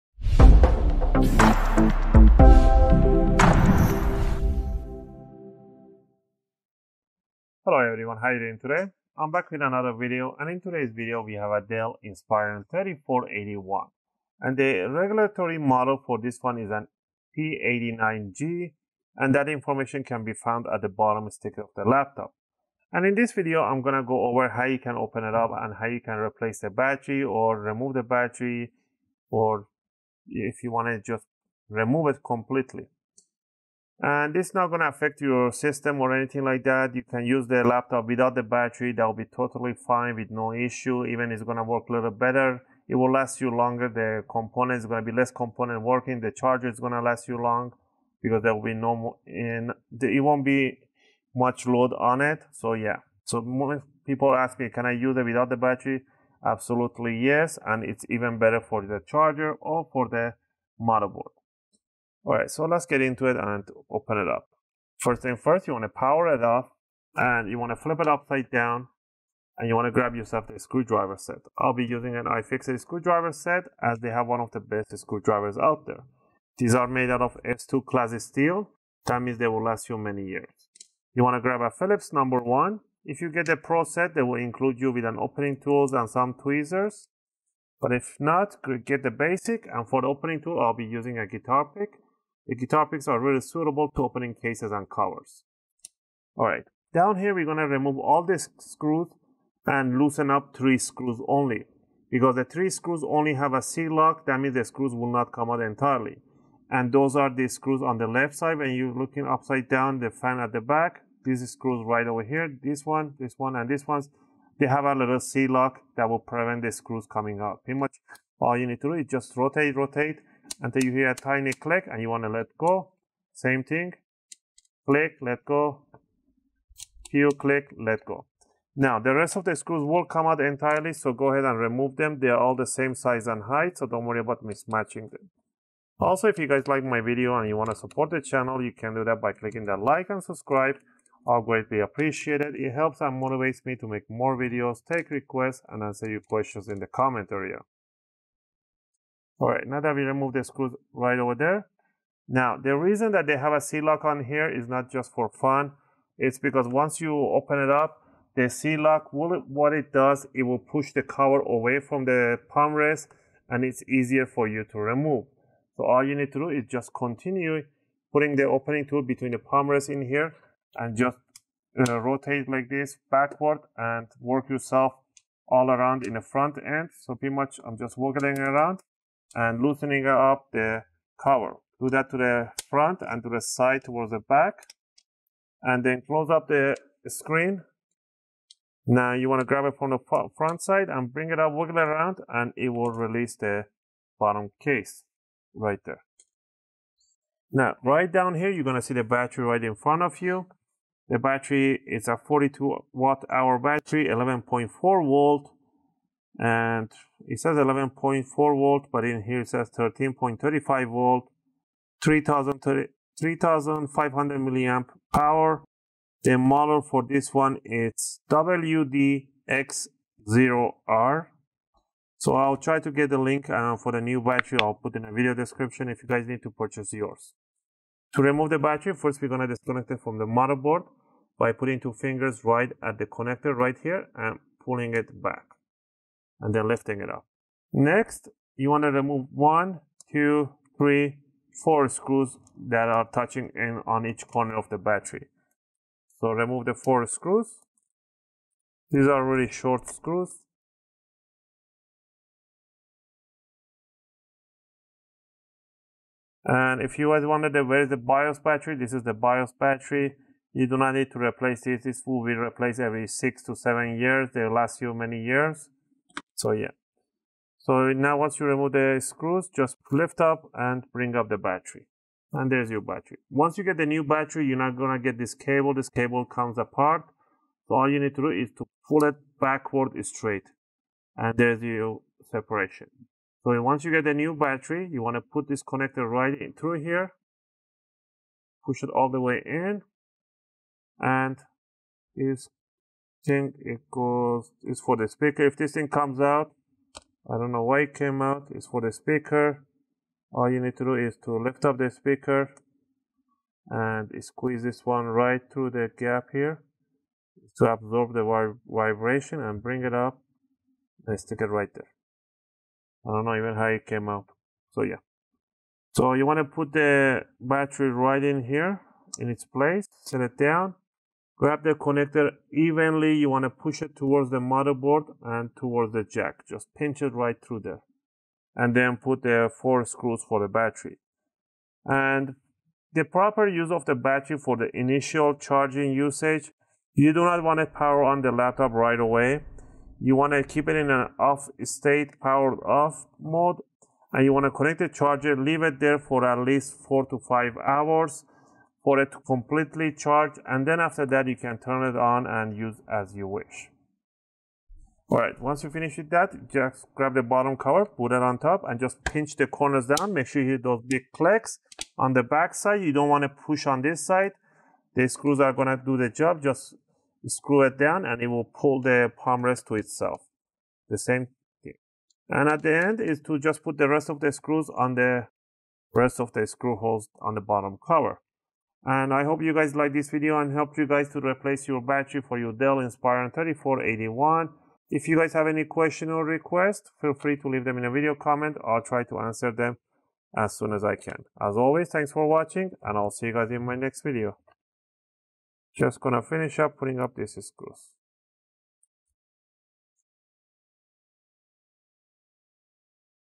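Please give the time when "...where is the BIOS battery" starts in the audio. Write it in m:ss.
4:17.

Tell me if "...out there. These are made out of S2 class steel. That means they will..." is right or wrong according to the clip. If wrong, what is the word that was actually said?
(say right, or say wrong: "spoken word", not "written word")
right.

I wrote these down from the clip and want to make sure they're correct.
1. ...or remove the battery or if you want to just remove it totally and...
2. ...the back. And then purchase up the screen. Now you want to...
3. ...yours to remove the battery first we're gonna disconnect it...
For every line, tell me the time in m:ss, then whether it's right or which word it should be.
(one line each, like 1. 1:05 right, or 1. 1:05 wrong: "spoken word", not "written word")
1. 0:27 wrong: "completely", not "totally"
2. 3:04 wrong: "close", not "purchase"
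3. 3:46 right.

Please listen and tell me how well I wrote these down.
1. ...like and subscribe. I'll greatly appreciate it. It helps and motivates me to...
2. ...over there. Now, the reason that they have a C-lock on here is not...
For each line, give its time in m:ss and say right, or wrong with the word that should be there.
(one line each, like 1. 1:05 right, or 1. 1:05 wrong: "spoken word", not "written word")
1. 2:19 right
2. 2:31 right.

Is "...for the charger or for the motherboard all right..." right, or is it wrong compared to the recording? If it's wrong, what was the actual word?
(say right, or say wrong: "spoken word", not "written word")
right.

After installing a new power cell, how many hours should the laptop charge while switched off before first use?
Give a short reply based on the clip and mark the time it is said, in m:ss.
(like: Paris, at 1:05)
4 to 5, at 5:46.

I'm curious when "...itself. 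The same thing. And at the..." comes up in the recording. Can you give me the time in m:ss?
6:09.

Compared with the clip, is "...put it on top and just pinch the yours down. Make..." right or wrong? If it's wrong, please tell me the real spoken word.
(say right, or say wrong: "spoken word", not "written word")
wrong: "corners", not "yours".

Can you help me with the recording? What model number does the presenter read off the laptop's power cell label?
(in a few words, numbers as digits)
WDX0R.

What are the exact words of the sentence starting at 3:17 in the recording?
Now, right down here, you're going to see the battery right in front of you.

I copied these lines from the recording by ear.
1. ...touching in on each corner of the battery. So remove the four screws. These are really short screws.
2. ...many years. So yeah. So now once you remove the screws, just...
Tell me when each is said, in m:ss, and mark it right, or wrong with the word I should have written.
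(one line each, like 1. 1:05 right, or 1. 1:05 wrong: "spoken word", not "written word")
1. 4:03 right
2. 4:24 right.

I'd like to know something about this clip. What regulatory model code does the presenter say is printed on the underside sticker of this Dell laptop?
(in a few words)
P89G.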